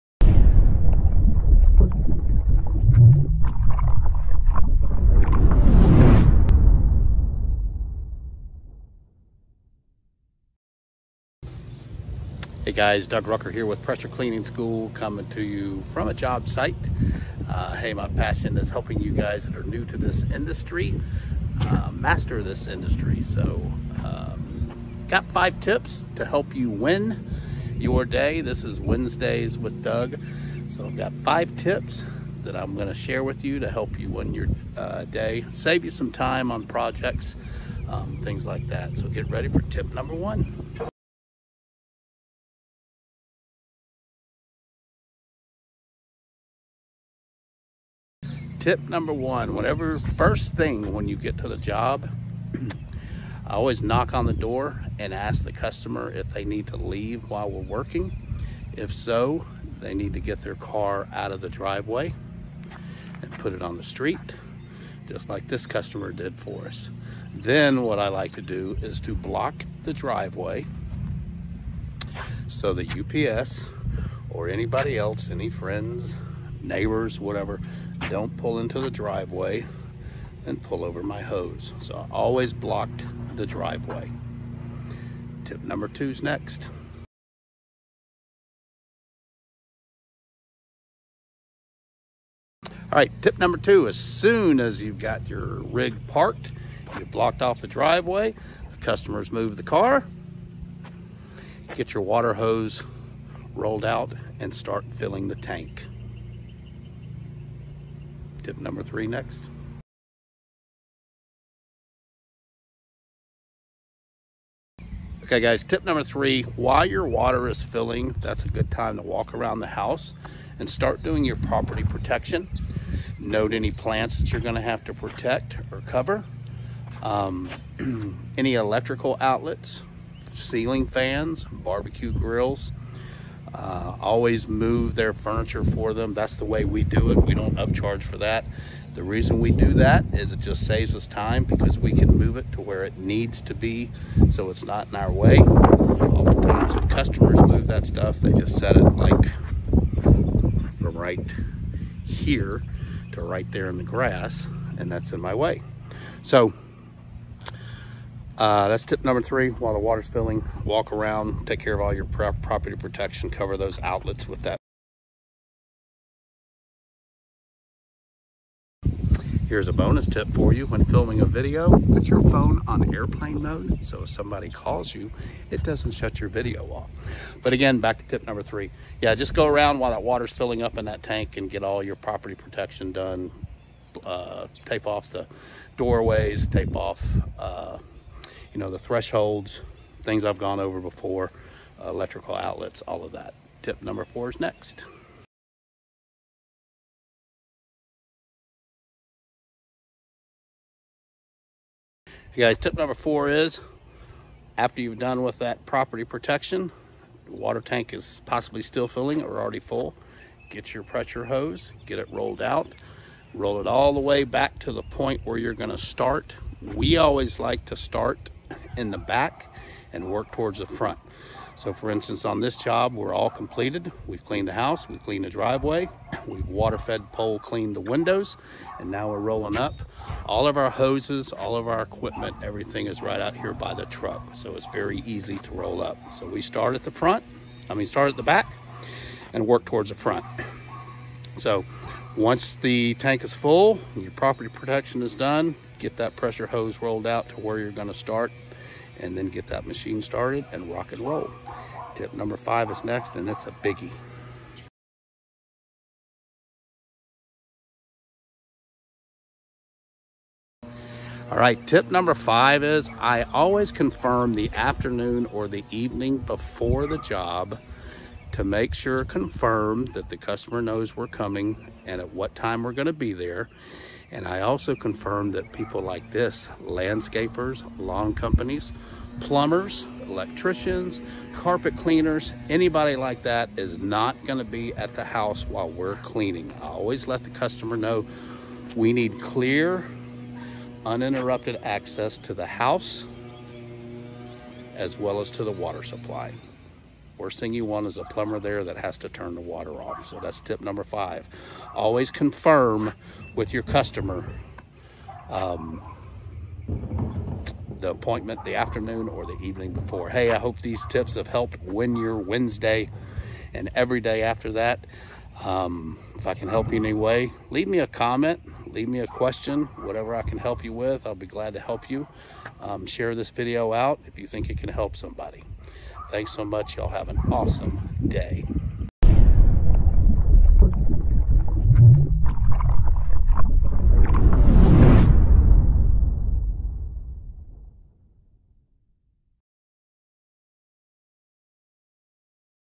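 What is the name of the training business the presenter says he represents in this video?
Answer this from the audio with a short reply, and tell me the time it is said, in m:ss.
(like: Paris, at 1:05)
Pressure Cleaning School, at 0:13.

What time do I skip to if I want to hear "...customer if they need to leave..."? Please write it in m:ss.
0:55.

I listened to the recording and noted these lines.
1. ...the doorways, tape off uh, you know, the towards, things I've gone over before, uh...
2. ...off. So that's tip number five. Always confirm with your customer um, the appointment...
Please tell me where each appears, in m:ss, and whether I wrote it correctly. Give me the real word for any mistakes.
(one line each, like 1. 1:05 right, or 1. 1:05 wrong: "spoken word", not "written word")
1. 3:05 wrong: "thresholds", not "towards"
2. 4:59 right.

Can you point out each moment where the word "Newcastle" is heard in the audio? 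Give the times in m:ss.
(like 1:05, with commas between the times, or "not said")
not said.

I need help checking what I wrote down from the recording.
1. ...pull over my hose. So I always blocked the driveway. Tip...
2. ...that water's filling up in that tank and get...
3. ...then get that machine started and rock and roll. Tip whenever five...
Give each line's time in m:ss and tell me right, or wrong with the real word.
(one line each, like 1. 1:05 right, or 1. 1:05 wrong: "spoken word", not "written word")
1. 1:20 right
2. 2:59 right
3. 4:09 wrong: "number", not "whenever".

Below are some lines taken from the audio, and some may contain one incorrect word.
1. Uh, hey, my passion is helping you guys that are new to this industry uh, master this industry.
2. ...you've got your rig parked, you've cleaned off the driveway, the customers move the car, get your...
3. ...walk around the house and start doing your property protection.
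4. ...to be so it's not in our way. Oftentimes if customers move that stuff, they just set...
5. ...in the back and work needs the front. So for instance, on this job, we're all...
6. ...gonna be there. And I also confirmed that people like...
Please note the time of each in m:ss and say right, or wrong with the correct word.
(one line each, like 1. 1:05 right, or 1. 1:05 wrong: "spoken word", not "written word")
1. 0:17 right
2. 1:34 wrong: "blocked", not "cleaned"
3. 1:59 right
4. 2:23 right
5. 3:38 wrong: "towards", not "needs"
6. 4:32 right.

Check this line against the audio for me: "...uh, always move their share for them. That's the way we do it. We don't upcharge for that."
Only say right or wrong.
wrong.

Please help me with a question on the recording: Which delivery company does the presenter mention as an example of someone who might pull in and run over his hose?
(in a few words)
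UPS.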